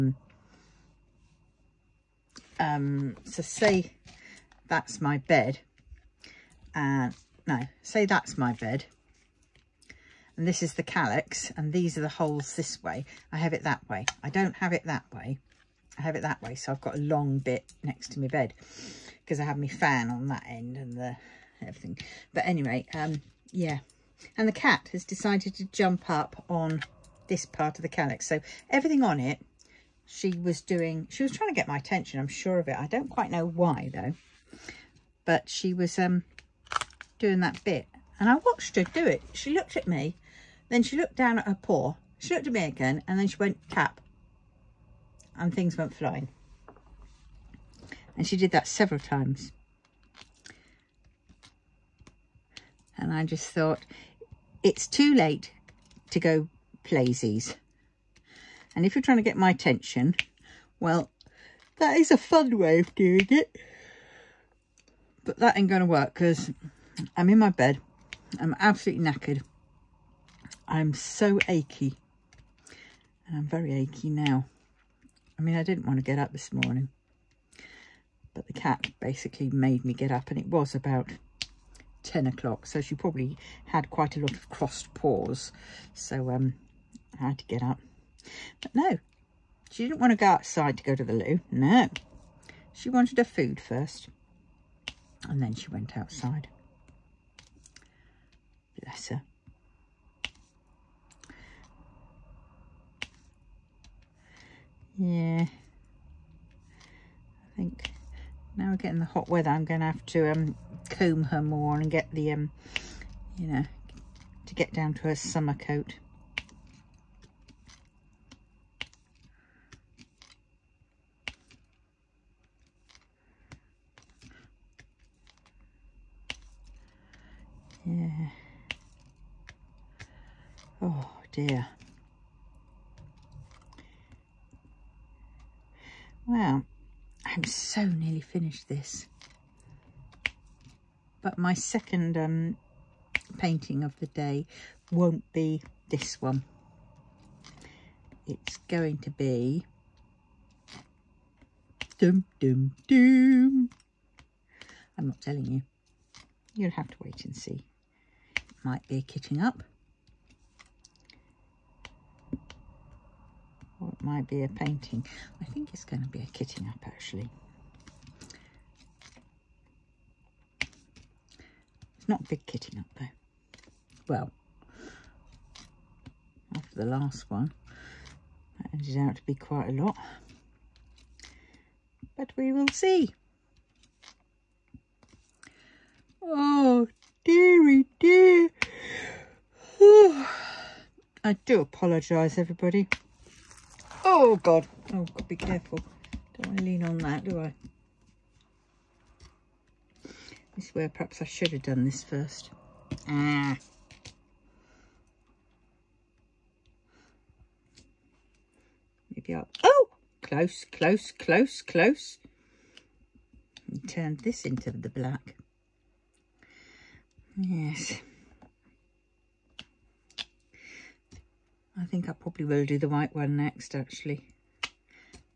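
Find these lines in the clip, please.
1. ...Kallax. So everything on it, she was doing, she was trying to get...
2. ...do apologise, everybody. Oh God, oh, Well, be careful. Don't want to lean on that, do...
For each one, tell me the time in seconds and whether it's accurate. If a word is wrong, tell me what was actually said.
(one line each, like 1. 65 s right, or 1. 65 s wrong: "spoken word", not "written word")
1. 27 s right
2. 191 s wrong: "God", not "Well".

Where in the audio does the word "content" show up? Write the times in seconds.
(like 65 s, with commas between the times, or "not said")
not said.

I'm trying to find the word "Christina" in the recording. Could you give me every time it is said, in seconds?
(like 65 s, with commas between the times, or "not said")
not said.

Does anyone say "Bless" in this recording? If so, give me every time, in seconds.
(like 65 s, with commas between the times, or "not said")
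98 s.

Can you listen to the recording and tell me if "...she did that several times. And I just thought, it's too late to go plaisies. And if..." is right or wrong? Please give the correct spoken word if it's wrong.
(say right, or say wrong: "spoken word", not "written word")
right.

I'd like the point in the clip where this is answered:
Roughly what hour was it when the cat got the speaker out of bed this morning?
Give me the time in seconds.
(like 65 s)
82 s.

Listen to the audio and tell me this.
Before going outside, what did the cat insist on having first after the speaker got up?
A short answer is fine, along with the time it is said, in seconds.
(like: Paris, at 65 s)
her food, at 93 s.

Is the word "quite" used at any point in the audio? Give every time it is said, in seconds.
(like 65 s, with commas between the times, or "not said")
33 s, 83 s, 179 s.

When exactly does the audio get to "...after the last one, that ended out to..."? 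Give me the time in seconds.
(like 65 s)
176 s.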